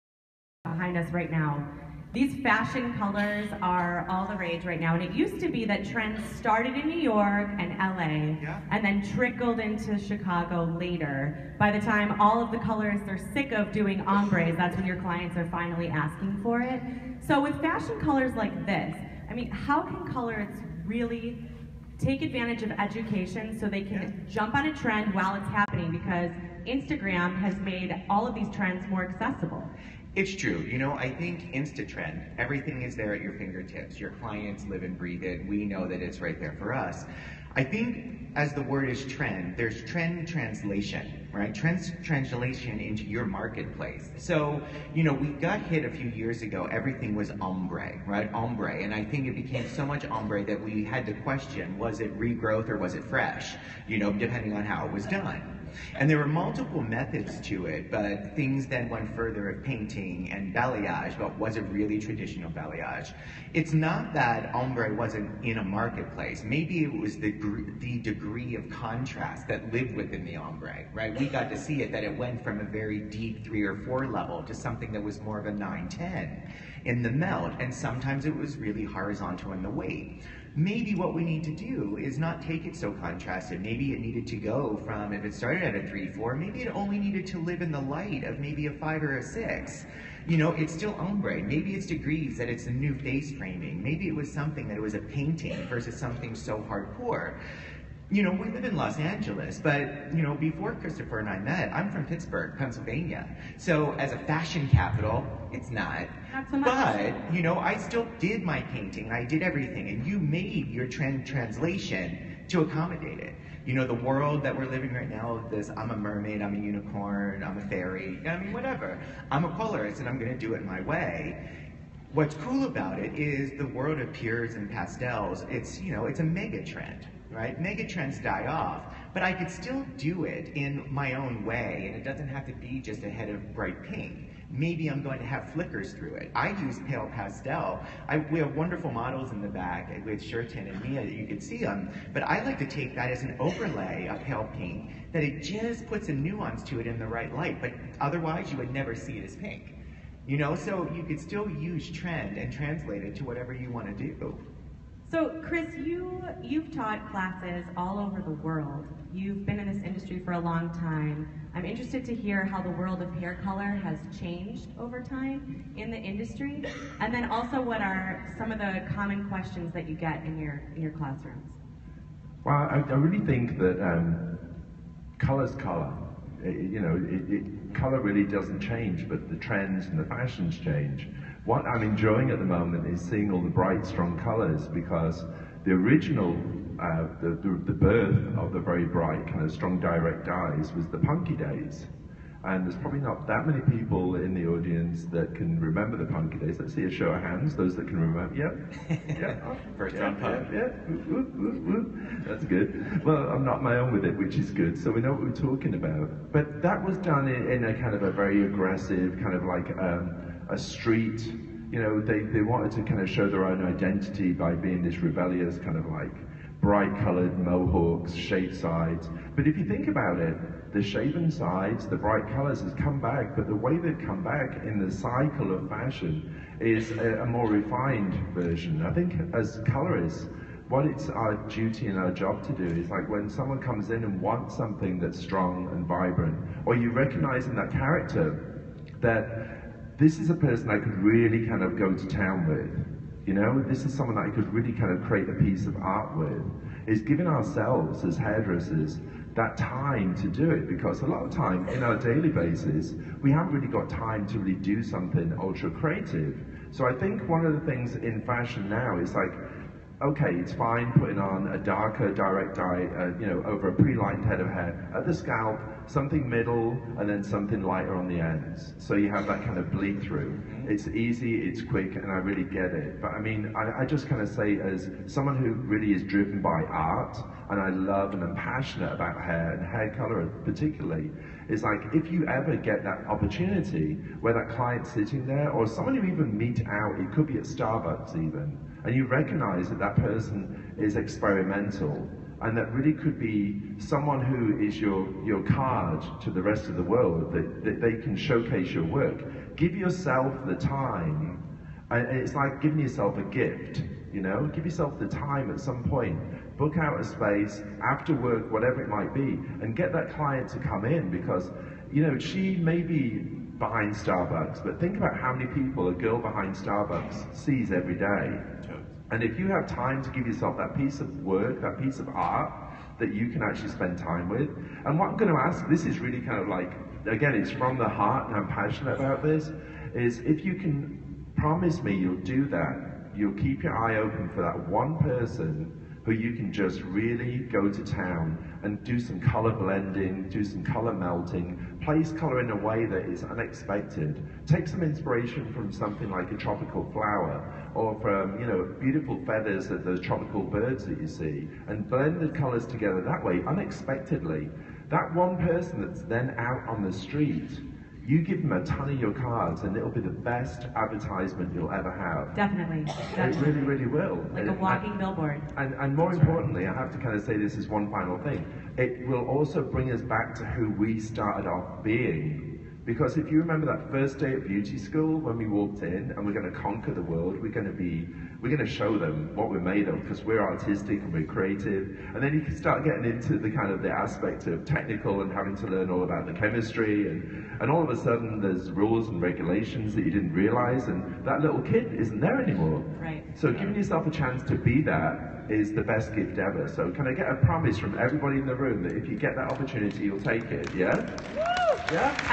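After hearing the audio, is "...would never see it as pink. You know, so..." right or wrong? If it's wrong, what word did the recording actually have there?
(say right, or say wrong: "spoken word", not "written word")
right.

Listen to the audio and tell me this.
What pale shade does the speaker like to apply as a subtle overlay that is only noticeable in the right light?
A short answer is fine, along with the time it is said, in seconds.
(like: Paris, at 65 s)
pale pink, at 144 s.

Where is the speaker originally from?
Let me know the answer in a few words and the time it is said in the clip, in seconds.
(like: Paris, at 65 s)
Pittsburgh, Pennsylvania, at 102 s.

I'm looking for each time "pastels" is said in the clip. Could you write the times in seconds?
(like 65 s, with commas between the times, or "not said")
124 s, 137 s.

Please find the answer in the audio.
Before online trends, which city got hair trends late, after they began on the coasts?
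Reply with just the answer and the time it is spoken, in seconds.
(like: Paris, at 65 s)
Chicago, at 9 s.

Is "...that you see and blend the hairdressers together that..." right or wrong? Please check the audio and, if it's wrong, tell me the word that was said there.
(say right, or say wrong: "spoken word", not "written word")
wrong: "colors", not "hairdressers".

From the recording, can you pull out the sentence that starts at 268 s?
So you have that kind of bleed through.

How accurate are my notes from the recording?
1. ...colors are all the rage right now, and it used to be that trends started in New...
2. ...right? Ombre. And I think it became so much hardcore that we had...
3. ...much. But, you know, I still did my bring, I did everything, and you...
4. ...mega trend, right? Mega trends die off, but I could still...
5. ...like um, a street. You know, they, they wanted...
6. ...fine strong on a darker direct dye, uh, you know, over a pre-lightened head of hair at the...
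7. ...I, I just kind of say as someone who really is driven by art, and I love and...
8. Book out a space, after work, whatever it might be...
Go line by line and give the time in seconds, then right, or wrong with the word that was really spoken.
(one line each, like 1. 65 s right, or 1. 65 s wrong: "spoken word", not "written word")
1. 2 s right
2. 48 s wrong: "ombre", not "hardcore"
3. 106 s wrong: "painting", not "bring"
4. 126 s right
5. 209 s right
6. 260 s wrong: "putting", not "strong"
7. 273 s right
8. 306 s right.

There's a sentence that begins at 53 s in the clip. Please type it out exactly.
You know, depending on how it was done.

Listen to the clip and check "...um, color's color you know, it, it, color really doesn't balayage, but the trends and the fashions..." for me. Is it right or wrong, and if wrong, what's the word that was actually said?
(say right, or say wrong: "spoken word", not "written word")
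wrong: "change", not "balayage".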